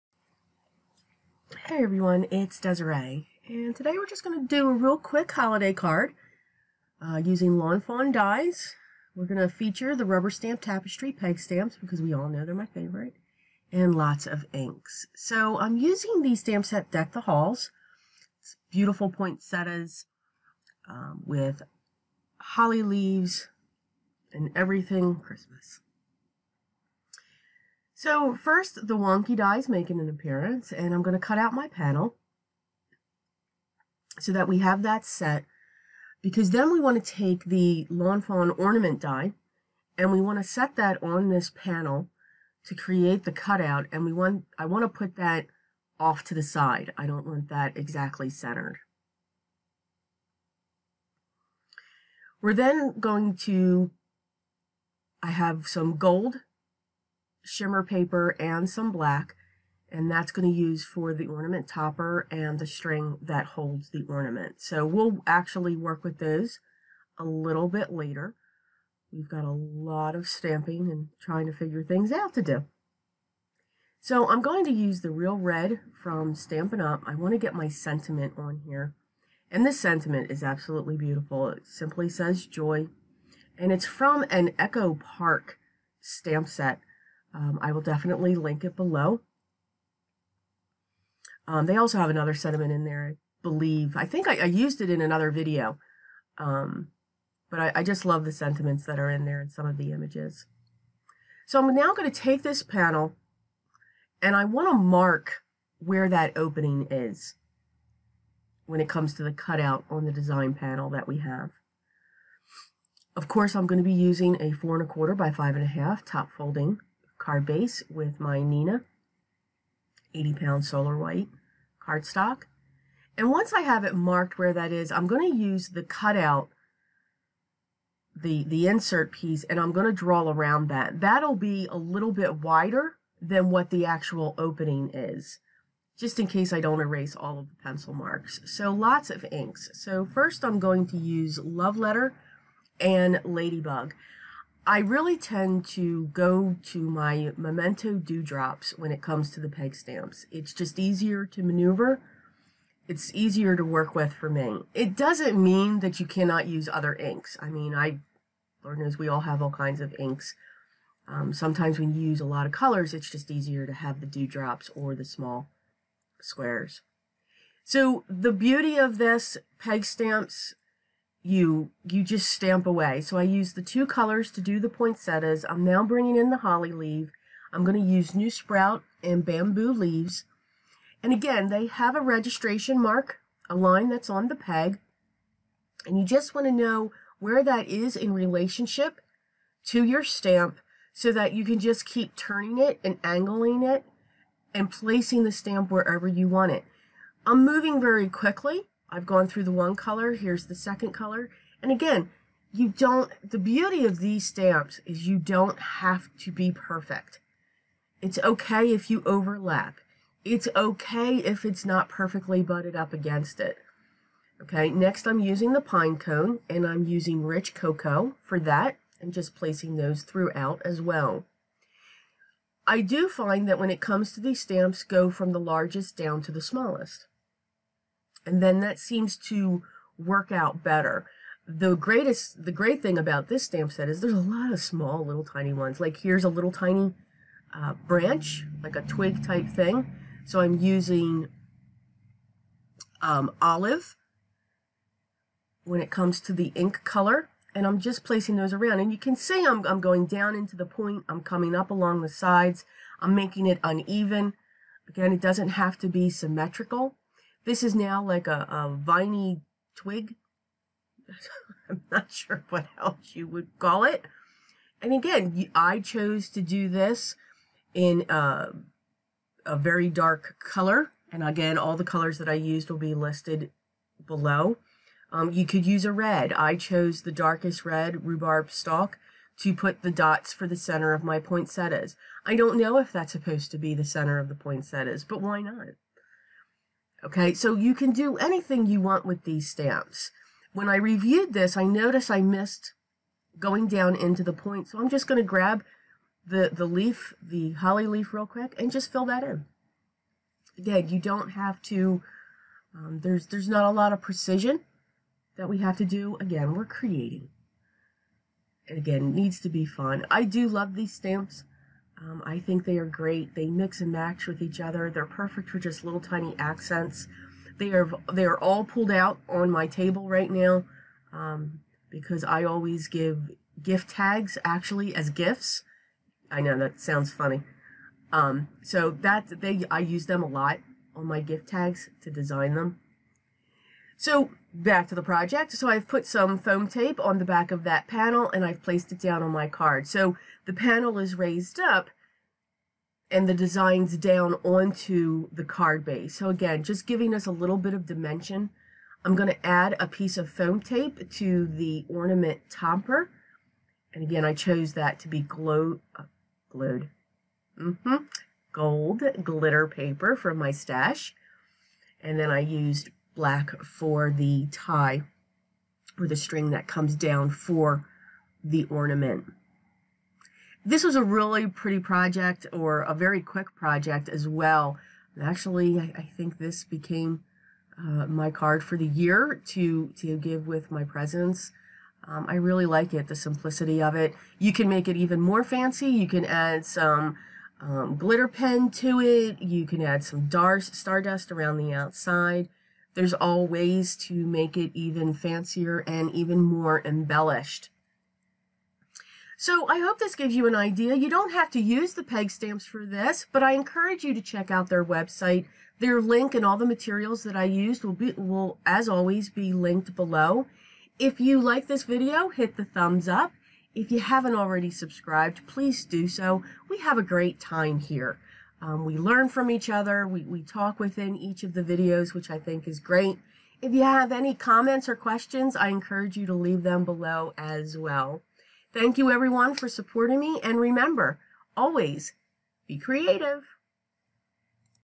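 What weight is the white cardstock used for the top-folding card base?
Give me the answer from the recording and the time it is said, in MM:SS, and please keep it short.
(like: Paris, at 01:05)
80 pound, at 02:00.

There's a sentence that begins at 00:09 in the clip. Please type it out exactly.
We're going to feature the rubber stamp tapestry peg stamps because we all know they're my favorite, and lots of inks.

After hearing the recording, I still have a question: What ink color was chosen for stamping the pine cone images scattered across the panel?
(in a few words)
Rich Cocoa.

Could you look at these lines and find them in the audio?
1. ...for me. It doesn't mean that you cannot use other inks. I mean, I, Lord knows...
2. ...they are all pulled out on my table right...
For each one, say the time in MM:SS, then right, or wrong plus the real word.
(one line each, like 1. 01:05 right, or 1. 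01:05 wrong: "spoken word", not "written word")
1. 02:34 right
2. 05:18 right.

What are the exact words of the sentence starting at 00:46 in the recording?
I don't want that exactly centered.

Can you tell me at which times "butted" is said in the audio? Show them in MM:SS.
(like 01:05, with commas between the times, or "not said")
03:32.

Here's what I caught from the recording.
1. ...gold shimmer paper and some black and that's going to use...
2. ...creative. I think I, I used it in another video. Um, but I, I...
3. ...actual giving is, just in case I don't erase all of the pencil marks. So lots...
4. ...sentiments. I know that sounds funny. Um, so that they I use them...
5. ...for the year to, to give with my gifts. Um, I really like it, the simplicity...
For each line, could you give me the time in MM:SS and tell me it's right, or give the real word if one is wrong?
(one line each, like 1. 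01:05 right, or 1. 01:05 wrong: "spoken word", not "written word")
1. 00:55 right
2. 01:33 wrong: "believe", not "creative"
3. 02:13 wrong: "opening", not "giving"
4. 05:25 wrong: "gifts", not "sentiments"
5. 06:18 wrong: "presents", not "gifts".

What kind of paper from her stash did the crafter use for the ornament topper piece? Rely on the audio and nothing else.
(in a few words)
Gold glitter paper.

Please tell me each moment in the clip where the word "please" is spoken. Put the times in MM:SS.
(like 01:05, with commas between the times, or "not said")
06:55.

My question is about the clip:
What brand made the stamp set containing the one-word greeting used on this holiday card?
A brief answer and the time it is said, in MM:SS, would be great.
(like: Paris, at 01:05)
Echo Park, at 01:24.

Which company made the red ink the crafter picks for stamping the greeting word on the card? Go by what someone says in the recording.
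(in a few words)
Stampin' Up.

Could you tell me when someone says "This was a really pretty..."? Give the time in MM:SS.
06:10.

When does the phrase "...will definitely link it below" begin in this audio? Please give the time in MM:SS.
01:27.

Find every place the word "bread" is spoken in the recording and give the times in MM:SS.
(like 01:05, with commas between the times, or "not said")
not said.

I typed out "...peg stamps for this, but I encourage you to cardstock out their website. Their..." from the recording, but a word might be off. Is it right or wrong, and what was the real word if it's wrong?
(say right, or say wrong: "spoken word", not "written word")
wrong: "check", not "cardstock".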